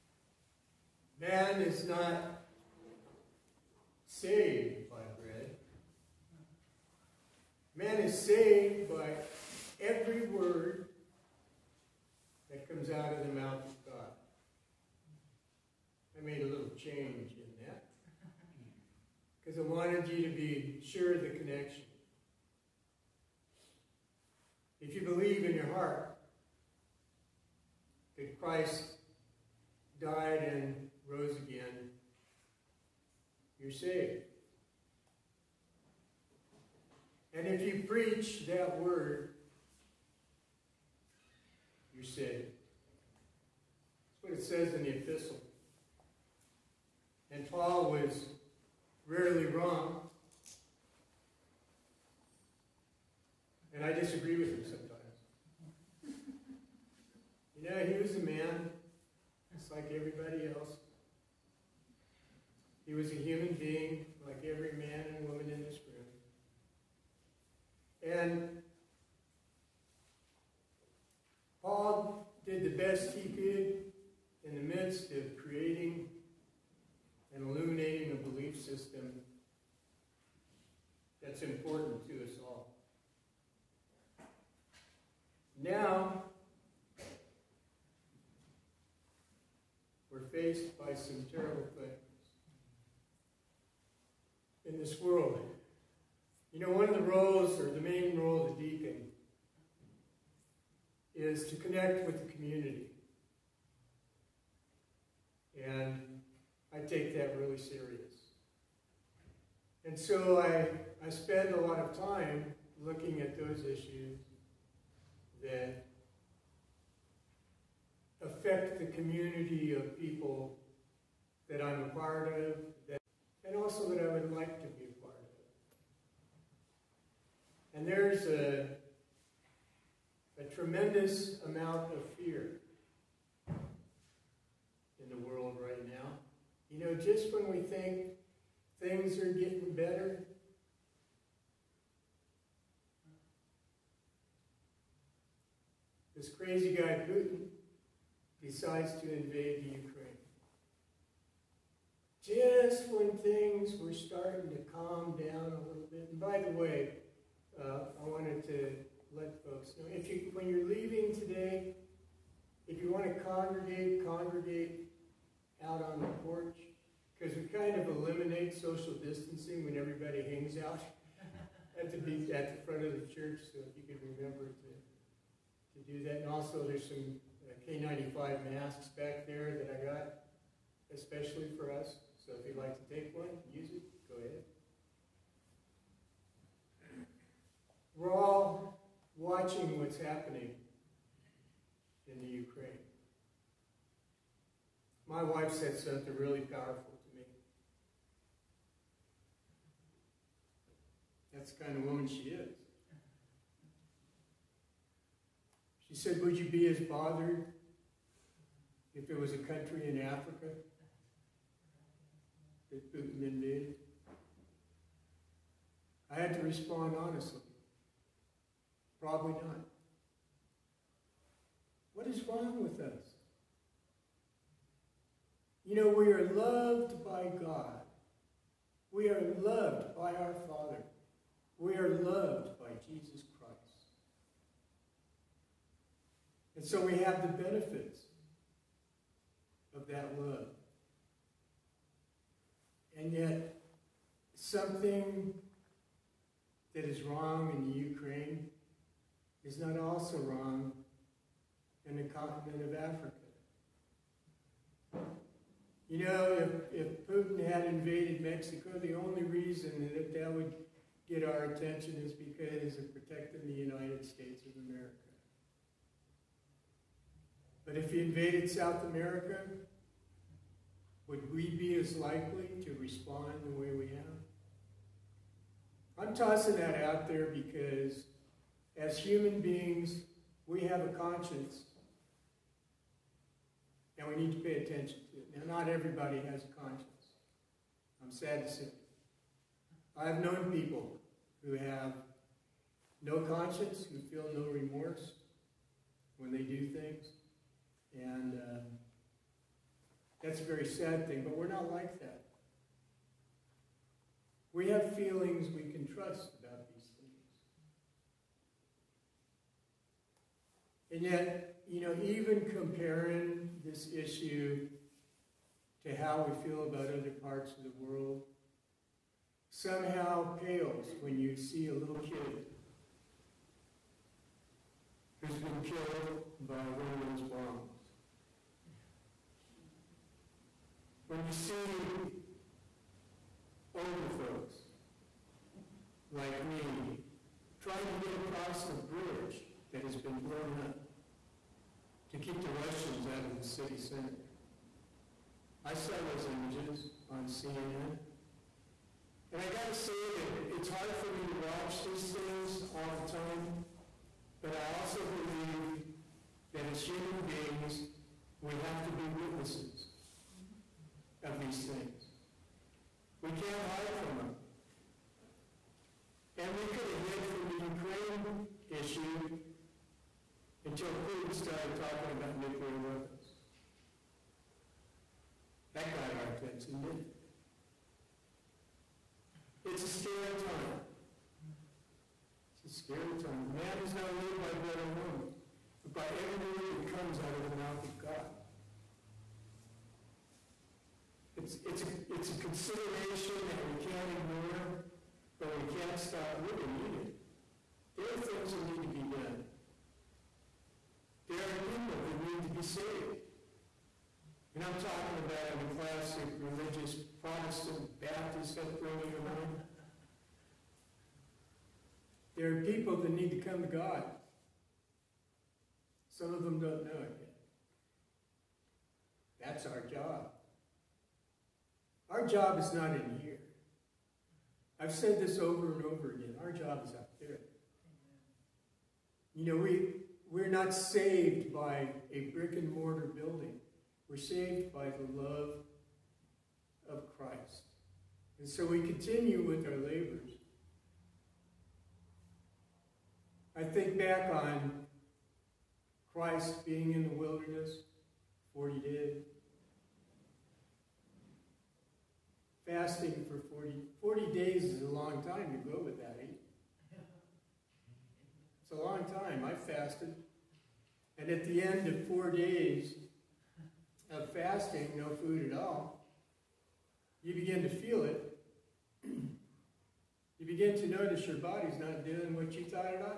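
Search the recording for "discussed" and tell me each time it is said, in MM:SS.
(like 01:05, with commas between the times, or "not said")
not said.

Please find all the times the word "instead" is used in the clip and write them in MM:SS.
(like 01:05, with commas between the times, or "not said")
not said.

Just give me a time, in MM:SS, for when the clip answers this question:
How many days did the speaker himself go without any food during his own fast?
07:42.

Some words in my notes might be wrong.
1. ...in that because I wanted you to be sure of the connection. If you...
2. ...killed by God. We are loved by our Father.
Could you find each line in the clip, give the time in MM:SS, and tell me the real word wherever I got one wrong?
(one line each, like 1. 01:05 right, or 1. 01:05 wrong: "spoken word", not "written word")
1. 00:17 right
2. 03:46 wrong: "loved", not "killed".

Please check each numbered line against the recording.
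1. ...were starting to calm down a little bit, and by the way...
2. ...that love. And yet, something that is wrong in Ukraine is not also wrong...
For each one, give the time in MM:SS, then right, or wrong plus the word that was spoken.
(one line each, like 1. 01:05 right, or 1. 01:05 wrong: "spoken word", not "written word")
1. 02:33 right
2. 03:59 right.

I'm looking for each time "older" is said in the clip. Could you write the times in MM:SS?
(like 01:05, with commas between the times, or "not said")
05:33.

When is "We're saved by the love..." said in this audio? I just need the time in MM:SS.
07:14.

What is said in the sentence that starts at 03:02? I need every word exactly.
So if you'd like to take one, use it, go ahead.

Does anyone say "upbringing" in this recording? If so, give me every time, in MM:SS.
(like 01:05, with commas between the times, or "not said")
06:48.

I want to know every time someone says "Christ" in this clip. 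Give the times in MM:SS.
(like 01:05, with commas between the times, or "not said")
00:28, 03:53, 07:17, 07:26.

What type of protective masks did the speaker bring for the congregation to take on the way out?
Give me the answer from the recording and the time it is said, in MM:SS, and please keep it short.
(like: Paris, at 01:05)
K95 masks, at 02:57.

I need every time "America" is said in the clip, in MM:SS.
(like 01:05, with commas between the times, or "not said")
04:24, 04:28.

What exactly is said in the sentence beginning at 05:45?
I saw those images on CNN.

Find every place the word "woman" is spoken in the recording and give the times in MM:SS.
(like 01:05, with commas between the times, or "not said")
01:05, 03:21.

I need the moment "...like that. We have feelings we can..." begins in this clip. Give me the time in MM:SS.
05:01.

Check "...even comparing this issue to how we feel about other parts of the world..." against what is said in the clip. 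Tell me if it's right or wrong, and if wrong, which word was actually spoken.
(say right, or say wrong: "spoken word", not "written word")
right.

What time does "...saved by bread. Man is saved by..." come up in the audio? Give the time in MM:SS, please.
00:04.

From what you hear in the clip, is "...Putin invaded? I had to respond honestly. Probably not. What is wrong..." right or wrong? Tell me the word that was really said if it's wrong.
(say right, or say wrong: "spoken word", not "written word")
right.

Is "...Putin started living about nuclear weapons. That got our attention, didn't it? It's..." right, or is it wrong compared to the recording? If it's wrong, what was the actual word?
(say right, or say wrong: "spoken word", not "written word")
wrong: "talking", not "living".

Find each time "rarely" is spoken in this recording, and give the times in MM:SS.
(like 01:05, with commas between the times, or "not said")
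00:49.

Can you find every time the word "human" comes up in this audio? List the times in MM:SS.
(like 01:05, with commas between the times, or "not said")
01:03, 04:38, 05:56.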